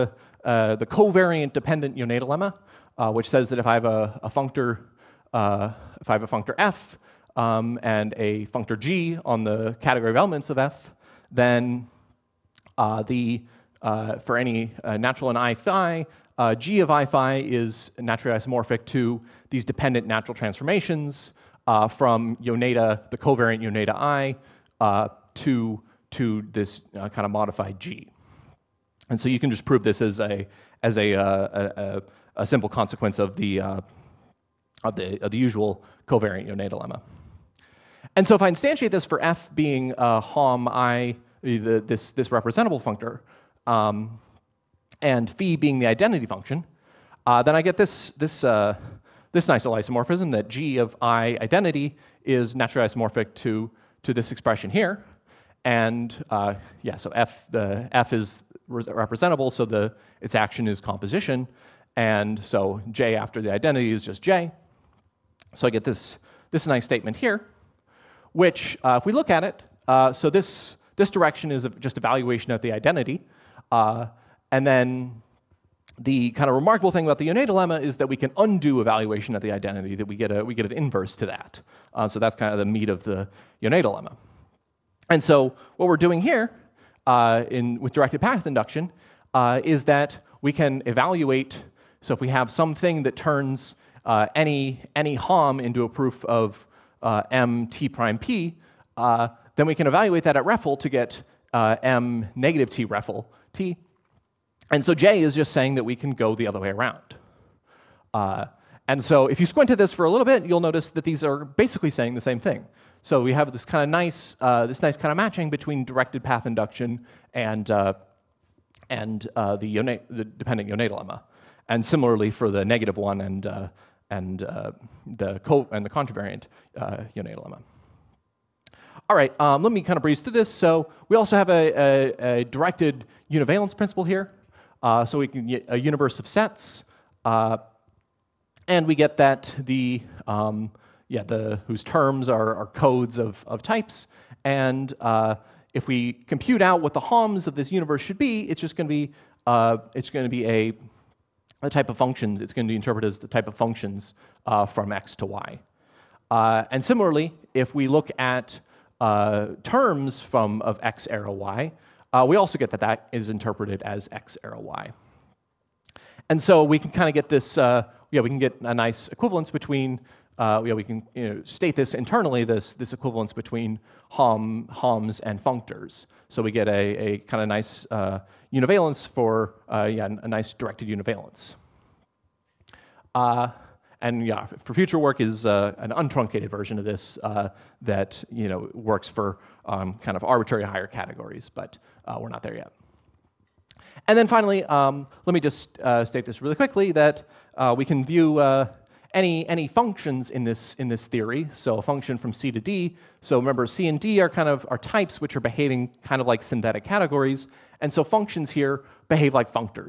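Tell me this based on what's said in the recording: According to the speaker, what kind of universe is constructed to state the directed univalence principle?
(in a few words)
A universe of sets.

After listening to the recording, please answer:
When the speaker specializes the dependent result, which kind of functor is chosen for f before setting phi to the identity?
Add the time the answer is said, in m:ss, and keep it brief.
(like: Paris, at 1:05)
Representable functor, at 0:42.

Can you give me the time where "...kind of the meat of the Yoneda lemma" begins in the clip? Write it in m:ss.
1:22.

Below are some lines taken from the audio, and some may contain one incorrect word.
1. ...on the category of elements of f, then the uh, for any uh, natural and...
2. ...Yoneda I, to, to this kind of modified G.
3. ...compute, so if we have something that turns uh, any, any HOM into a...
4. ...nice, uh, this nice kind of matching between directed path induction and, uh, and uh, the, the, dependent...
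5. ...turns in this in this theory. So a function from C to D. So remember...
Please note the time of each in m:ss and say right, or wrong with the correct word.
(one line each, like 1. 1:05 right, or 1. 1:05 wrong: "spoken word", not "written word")
1. 0:09 right
2. 0:23 right
3. 1:30 wrong: "evaluate", not "compute"
4. 1:53 right
5. 3:19 wrong: "functions", not "turns".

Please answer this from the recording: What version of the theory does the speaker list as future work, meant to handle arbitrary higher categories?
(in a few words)
An untruncated version.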